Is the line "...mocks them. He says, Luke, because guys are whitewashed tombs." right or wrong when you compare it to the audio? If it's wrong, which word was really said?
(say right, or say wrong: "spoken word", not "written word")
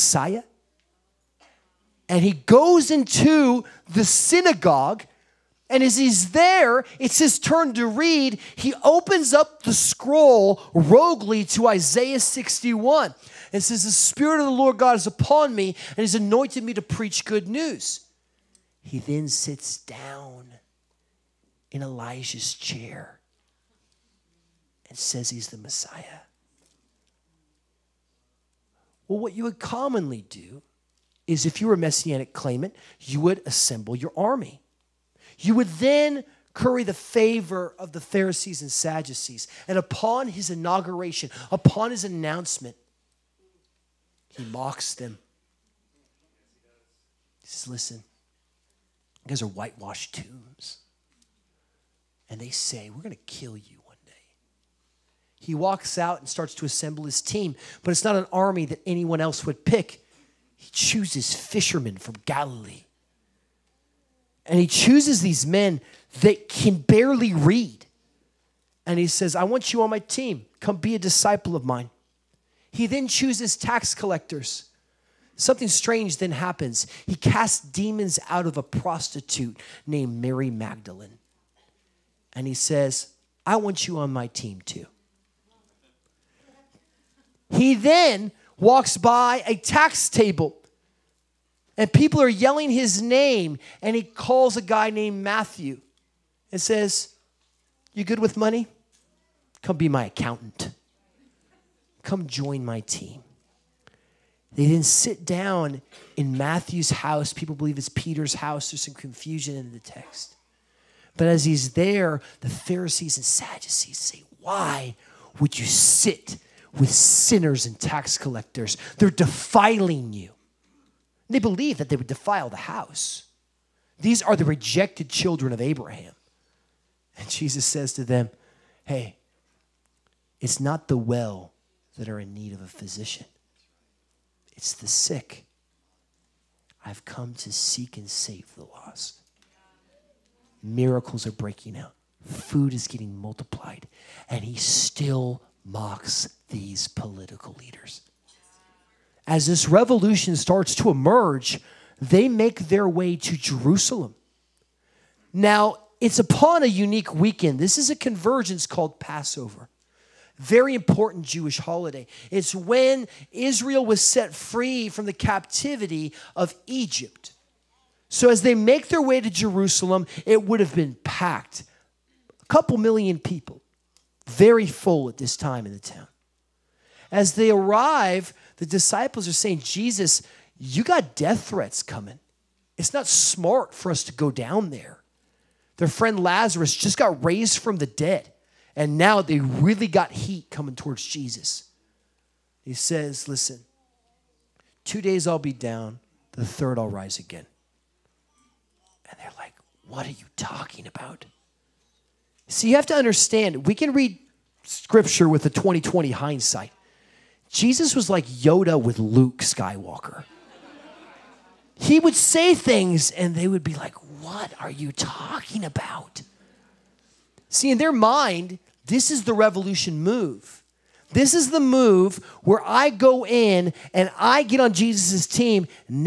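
wrong: "Listen", not "Luke".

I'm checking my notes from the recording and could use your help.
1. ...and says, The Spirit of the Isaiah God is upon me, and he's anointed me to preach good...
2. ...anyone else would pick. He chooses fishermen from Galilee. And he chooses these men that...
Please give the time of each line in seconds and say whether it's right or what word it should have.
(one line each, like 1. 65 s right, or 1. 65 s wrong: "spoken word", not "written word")
1. 13 s wrong: "Lord", not "Isaiah"
2. 58 s right.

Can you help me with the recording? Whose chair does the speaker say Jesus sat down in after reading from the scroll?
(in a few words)
Elijah's chair.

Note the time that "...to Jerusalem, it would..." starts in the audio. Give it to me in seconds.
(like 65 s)
169 s.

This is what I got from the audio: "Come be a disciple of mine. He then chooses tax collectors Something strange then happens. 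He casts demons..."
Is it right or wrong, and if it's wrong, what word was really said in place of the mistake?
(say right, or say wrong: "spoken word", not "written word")
right.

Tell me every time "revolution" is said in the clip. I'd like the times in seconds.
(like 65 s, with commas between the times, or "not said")
149 s, 219 s.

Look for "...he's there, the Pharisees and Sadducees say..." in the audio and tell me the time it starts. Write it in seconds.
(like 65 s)
111 s.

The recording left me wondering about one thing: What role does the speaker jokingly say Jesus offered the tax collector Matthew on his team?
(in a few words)
Accountant.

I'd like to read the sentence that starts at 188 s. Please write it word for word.
And now they really got heat coming towards Jesus.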